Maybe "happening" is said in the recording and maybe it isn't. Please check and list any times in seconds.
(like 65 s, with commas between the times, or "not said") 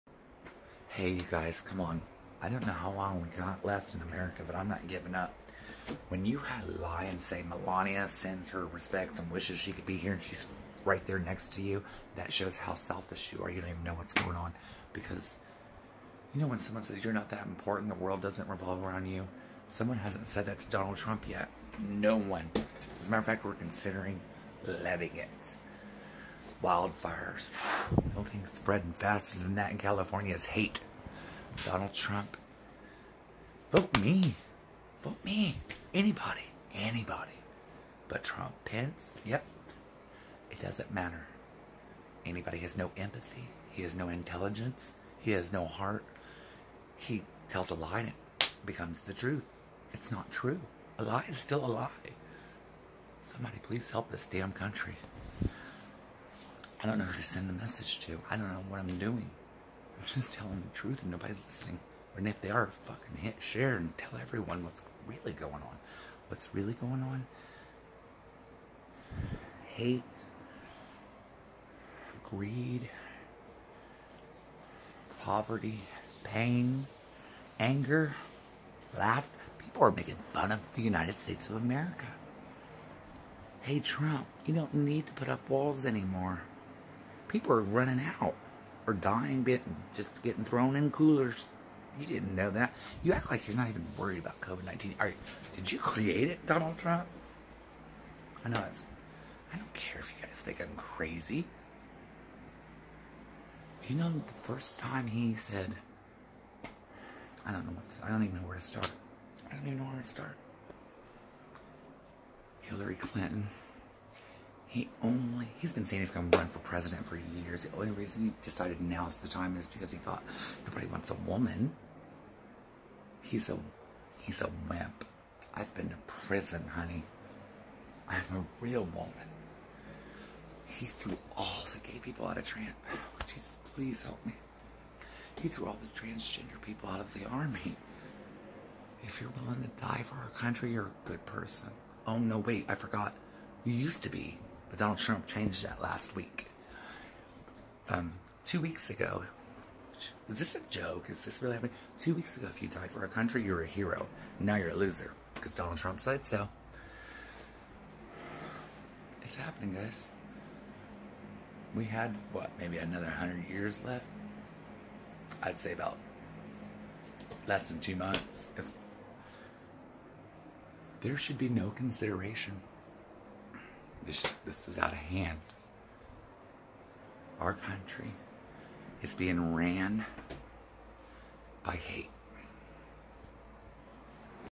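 151 s, 159 s.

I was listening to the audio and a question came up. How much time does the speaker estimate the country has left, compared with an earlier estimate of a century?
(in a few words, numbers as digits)
less than 2 months.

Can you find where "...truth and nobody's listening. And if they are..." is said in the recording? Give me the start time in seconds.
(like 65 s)
60 s.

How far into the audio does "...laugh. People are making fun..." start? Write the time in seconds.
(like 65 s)
78 s.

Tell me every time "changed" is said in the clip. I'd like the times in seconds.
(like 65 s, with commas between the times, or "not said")
145 s.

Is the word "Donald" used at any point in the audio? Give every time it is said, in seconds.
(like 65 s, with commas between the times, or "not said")
20 s, 31 s, 96 s, 144 s, 155 s.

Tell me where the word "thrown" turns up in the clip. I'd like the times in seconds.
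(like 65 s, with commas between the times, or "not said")
90 s.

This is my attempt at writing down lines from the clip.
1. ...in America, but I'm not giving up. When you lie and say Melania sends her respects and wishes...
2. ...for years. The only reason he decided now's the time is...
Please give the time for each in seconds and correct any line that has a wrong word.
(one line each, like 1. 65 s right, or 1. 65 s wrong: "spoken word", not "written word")
1. 3 s right
2. 117 s right.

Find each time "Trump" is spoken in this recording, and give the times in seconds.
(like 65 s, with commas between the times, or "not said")
20 s, 31 s, 38 s, 83 s, 96 s, 144 s, 155 s.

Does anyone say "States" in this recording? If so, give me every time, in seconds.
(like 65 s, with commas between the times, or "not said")
81 s.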